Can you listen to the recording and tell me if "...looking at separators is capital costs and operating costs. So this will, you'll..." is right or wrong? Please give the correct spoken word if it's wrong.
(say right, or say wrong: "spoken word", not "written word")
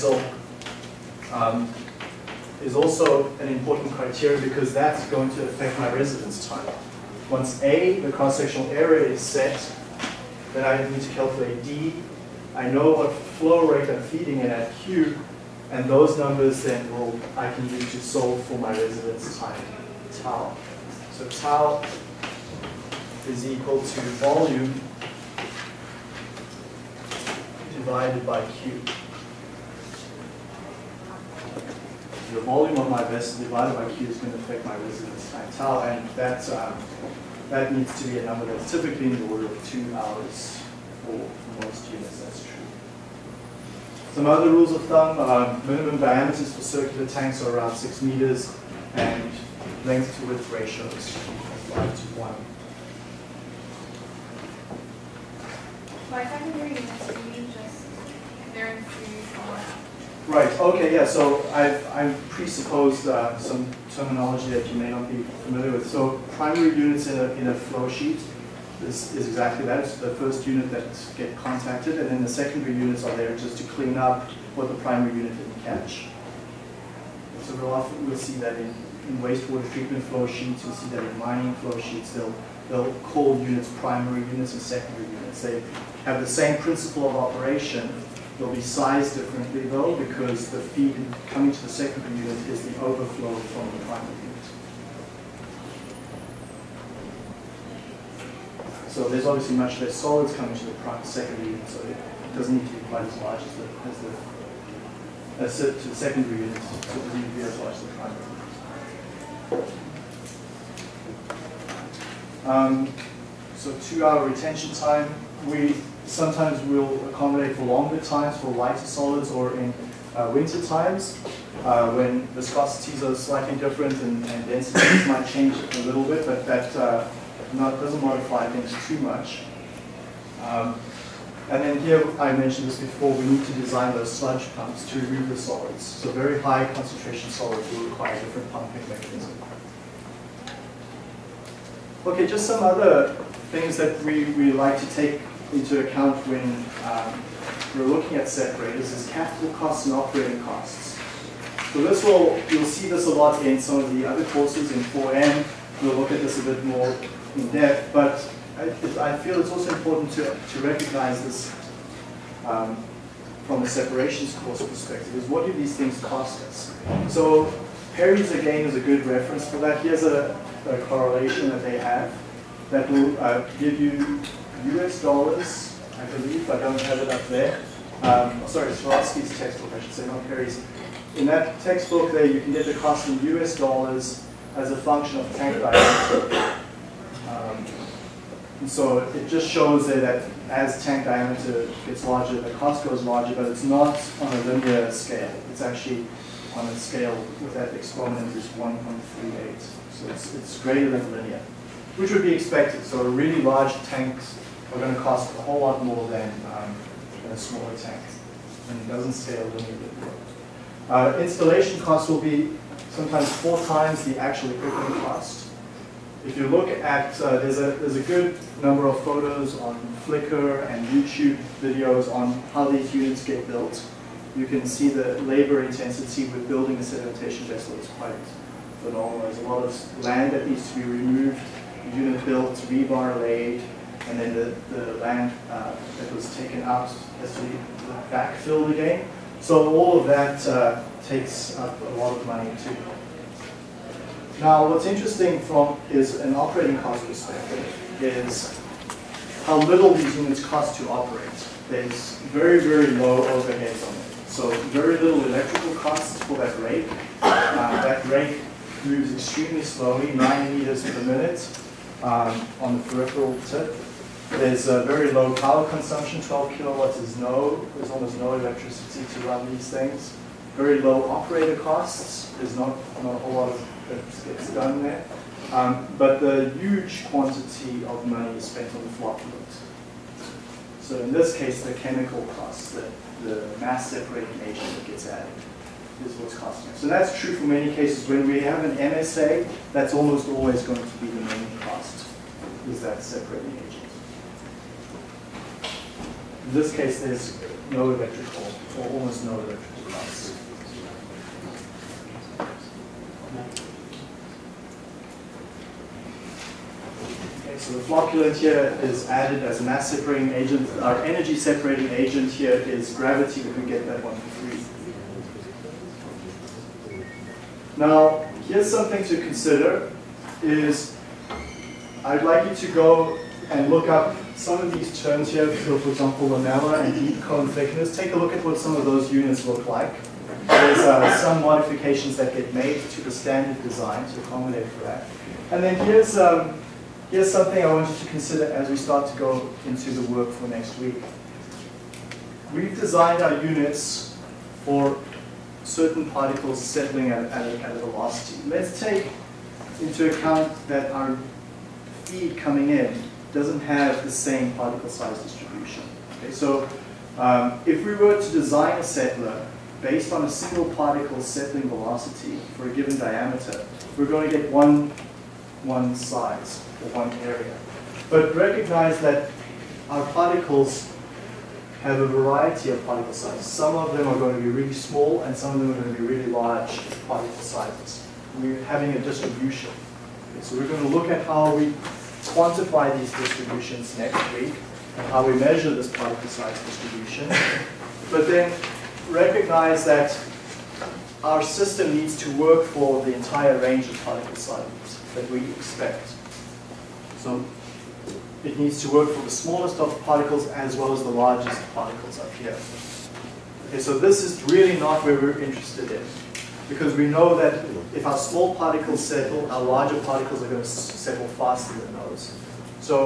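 right.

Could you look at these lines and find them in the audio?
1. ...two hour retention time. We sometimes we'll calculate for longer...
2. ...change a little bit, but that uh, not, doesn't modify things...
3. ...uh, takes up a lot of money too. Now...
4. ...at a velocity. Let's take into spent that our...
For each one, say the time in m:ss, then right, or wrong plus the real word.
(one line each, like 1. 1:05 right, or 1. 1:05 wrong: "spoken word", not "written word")
1. 1:53 wrong: "accommodate", not "calculate"
2. 2:05 right
3. 4:00 right
4. 5:47 wrong: "account", not "spent".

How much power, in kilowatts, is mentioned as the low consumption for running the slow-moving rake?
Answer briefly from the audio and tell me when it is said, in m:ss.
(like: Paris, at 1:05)
12 kilowatts, at 4:26.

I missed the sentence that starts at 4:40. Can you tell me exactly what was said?
So in this case, the chemical costs, the, the mass separating agent that gets added is what's costing us.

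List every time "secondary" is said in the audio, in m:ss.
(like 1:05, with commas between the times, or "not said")
0:56, 1:12, 1:24, 1:31, 1:41, 1:45.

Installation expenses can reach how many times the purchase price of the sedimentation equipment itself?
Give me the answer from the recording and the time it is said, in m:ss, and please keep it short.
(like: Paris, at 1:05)
4 times, at 3:33.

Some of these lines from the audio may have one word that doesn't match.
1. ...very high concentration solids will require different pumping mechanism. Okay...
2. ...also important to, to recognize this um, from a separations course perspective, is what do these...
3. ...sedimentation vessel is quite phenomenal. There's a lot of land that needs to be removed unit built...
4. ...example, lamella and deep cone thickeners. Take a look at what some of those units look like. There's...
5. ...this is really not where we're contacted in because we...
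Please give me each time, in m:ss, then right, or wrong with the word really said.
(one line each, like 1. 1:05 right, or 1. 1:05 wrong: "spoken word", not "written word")
1. 2:16 right
2. 2:39 right
3. 3:46 right
4. 5:25 right
5. 6:43 wrong: "interested", not "contacted".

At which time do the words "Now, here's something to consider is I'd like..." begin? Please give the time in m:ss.
5:17.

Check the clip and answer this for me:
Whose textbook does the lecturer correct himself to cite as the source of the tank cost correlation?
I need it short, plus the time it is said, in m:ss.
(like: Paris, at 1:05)
Svarovsky, at 2:58.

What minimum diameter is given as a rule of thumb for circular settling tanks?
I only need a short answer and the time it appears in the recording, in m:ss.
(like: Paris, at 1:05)
6 meters, at 0:47.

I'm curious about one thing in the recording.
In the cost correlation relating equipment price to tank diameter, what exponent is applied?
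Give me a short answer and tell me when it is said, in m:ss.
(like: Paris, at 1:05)
1.38, at 3:18.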